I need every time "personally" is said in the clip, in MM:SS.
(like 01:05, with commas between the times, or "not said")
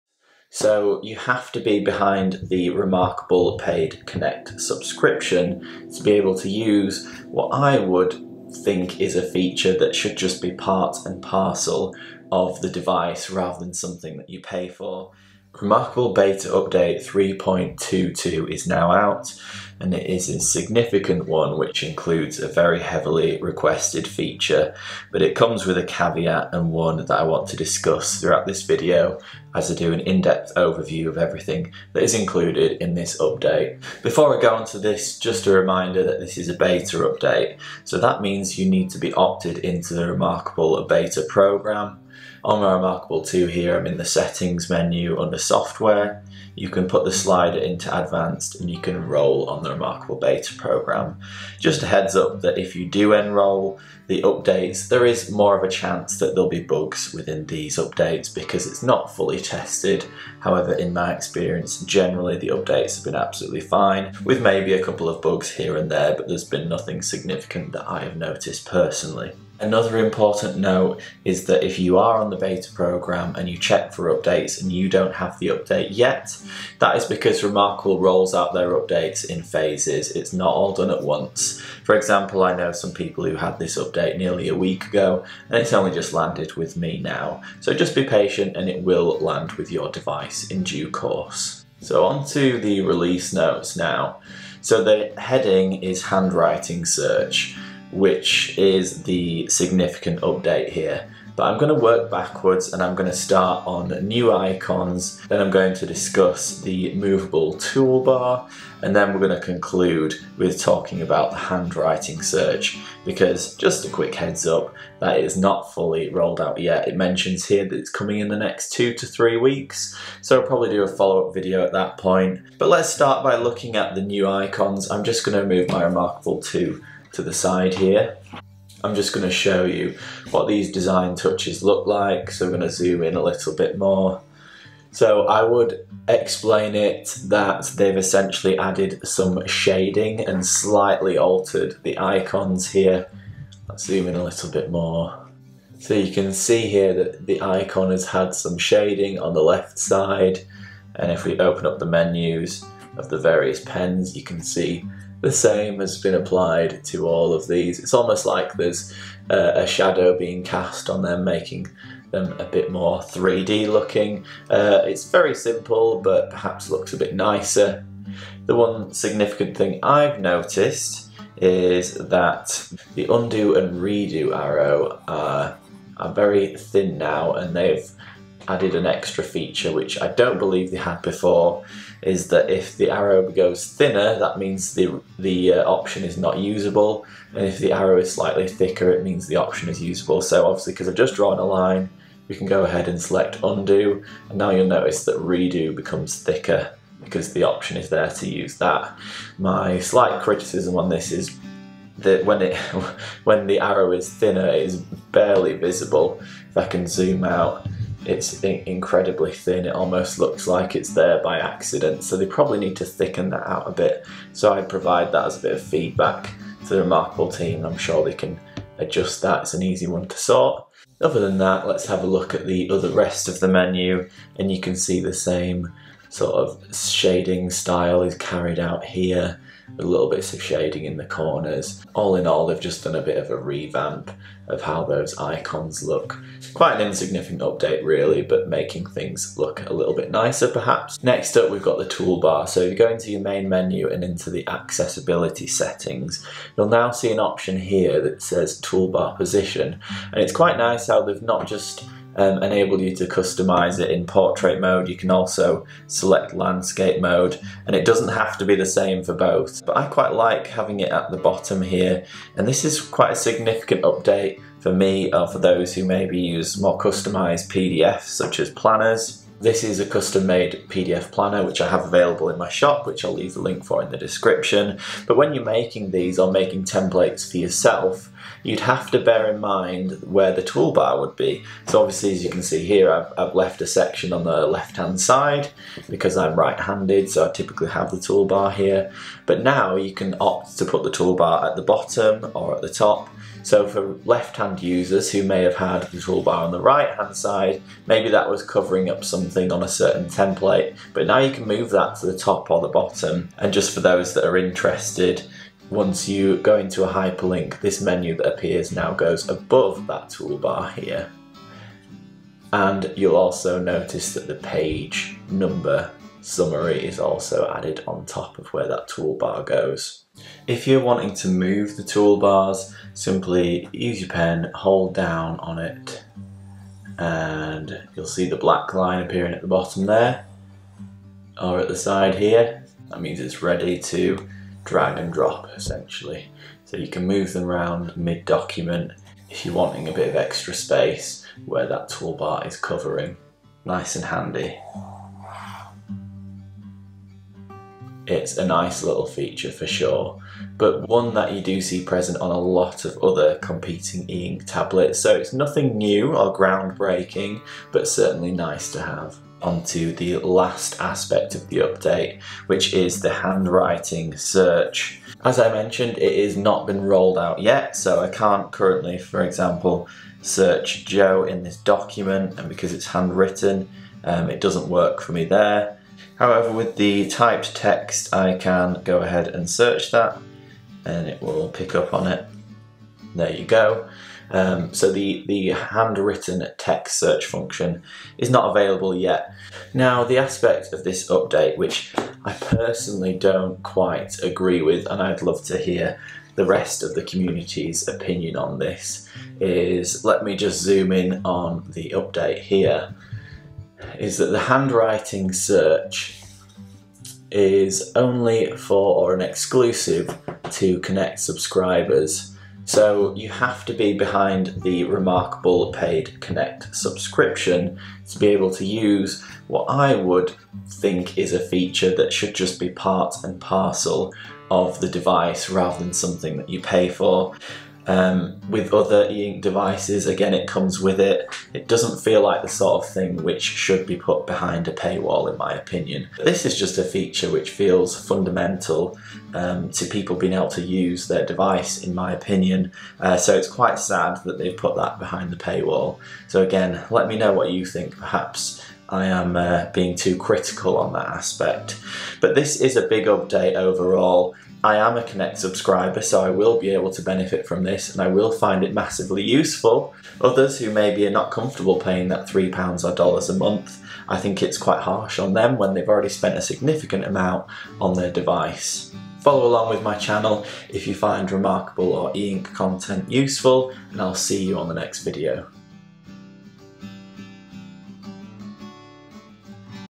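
01:08, 06:32.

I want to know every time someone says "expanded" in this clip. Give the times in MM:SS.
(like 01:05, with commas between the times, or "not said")
not said.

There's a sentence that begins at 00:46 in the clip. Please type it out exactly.
You can put the slider into advanced and you can enroll on the Remarkable Beta program.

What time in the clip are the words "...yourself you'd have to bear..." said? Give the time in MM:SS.
04:37.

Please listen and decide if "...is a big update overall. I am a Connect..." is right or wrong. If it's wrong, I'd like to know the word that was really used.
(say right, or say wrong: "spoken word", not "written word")
right.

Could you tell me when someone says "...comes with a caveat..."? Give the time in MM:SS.
00:25.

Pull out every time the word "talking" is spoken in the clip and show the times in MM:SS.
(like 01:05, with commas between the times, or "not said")
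01:50.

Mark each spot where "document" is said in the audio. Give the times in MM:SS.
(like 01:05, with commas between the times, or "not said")
05:37, 06:11.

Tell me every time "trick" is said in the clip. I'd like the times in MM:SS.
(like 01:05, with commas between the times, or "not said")
not said.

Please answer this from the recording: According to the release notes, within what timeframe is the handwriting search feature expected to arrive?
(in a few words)
two to three weeks.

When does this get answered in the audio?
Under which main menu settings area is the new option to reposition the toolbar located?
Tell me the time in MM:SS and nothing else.
04:04.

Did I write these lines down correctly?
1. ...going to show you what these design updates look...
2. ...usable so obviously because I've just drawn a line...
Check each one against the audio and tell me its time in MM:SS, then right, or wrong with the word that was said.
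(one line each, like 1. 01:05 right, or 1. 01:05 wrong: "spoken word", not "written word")
1. 02:09 wrong: "touches", not "updates"
2. 03:09 right.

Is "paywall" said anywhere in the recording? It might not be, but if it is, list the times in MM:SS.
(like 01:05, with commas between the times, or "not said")
07:14, 07:25.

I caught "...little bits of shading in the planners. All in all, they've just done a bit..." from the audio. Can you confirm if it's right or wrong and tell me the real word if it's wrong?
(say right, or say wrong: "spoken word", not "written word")
wrong: "corners", not "planners".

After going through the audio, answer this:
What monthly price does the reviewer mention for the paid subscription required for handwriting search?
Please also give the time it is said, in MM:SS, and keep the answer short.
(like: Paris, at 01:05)
£3, at 07:42.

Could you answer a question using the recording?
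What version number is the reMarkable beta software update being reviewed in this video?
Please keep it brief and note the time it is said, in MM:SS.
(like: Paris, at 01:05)
3.22, at 00:17.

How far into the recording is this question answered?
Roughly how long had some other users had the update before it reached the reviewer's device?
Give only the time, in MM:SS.
01:24.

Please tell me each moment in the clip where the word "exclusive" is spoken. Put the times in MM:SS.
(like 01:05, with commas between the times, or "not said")
06:49.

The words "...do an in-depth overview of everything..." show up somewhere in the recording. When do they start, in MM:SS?
00:29.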